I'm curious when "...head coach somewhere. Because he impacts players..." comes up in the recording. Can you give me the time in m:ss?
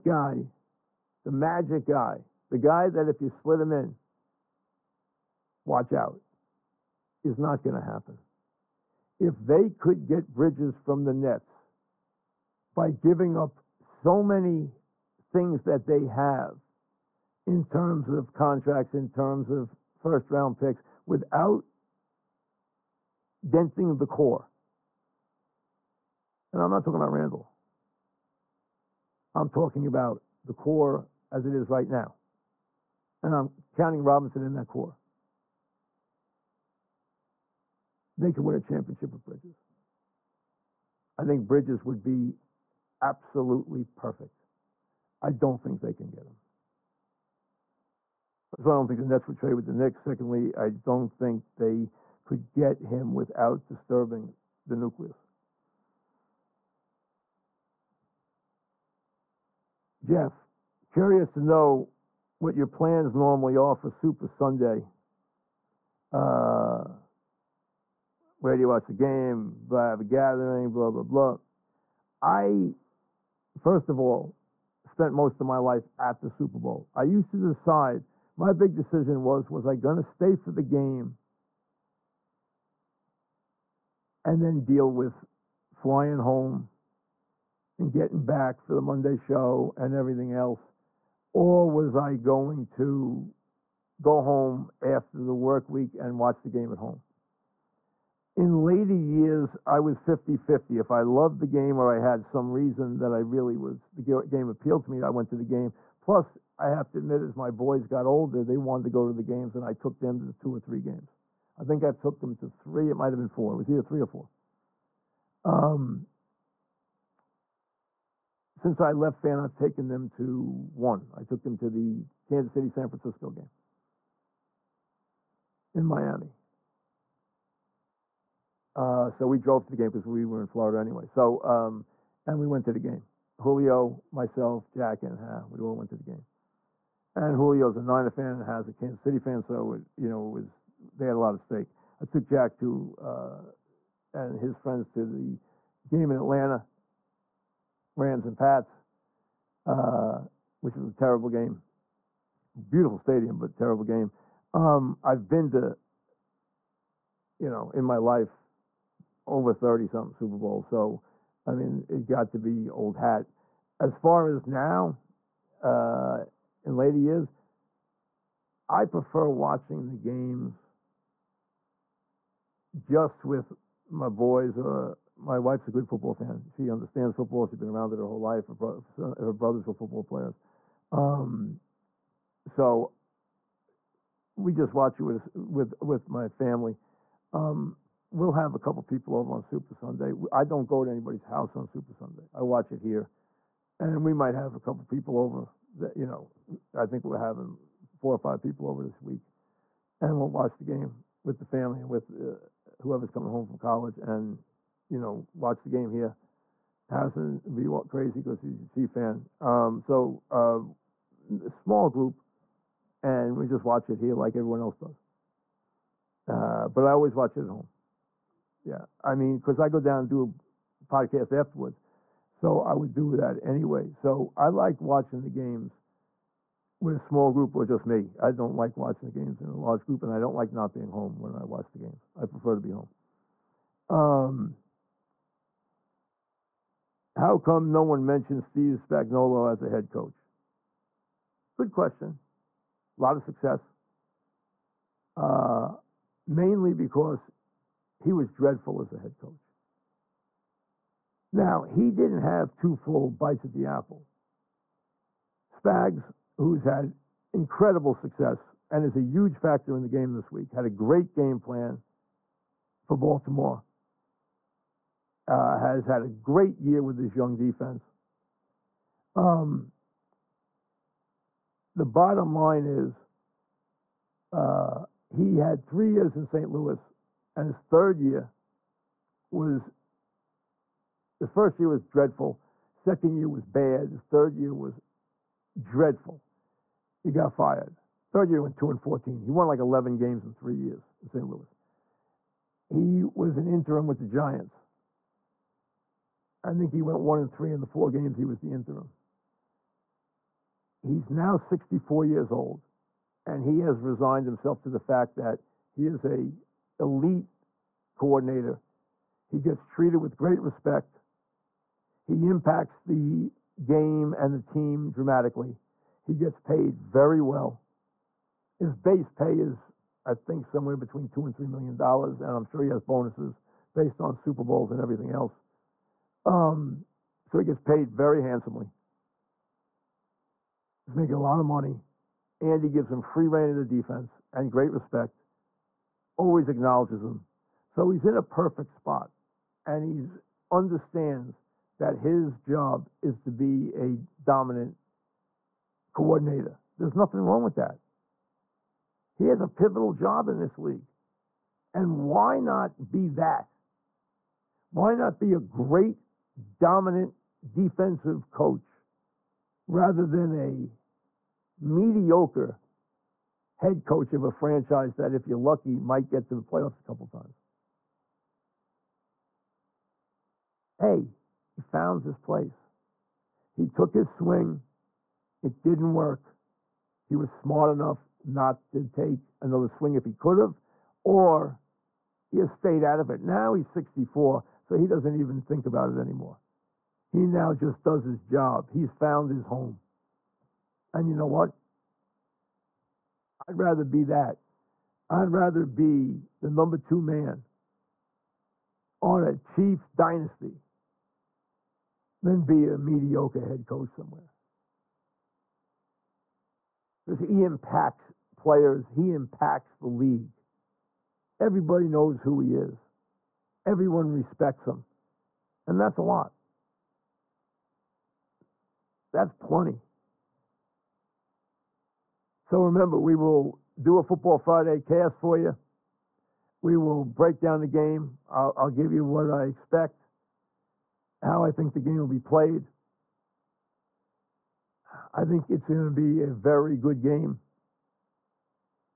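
6:43.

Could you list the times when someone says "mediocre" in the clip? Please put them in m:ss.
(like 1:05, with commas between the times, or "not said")
6:01, 6:42.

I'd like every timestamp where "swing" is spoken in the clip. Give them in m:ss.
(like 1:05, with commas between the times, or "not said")
6:14, 6:19.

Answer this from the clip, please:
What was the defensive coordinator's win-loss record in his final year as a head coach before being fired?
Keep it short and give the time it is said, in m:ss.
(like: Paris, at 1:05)
2-14, at 4:48.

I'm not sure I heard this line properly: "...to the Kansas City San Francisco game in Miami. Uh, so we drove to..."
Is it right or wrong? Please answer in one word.
right.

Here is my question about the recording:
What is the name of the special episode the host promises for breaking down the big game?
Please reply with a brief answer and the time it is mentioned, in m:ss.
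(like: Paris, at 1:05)
Football Friday cast, at 7:04.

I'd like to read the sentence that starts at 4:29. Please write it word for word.
Um, the bottom line is uh, he had three years in St.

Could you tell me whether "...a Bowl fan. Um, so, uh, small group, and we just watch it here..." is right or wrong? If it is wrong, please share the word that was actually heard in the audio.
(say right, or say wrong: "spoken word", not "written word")
wrong: "Chief", not "Bowl".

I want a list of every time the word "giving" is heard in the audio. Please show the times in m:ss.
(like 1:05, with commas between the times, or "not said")
0:12.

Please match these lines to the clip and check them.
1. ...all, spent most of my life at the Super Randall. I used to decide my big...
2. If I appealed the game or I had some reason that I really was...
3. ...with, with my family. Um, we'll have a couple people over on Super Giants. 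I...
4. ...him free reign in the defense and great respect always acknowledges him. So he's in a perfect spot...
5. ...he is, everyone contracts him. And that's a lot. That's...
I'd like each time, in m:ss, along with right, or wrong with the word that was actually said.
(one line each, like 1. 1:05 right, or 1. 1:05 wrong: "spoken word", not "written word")
1. 1:13 wrong: "Bowl", not "Randall"
2. 1:40 wrong: "loved", not "appealed"
3. 3:05 wrong: "Sunday", not "Giants"
4. 5:32 right
5. 6:52 wrong: "respects", not "contracts".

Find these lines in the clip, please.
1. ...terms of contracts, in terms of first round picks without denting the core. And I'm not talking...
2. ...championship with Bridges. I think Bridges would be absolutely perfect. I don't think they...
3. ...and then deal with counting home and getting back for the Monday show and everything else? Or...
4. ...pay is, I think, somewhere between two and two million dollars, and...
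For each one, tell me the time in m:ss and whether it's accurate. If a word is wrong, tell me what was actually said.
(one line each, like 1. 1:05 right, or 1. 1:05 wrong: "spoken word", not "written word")
1. 0:17 right
2. 0:38 right
3. 1:24 wrong: "flying", not "counting"
4. 5:19 wrong: "three", not "two".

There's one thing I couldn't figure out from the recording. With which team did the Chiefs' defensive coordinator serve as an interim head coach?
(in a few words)
Giants.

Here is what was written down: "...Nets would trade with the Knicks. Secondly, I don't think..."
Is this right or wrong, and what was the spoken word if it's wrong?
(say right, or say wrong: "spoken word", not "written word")
right.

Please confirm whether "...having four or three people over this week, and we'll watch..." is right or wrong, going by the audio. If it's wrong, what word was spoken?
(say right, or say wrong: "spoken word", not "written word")
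wrong: "five", not "three".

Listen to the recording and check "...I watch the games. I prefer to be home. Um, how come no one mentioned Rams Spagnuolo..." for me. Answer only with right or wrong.
wrong.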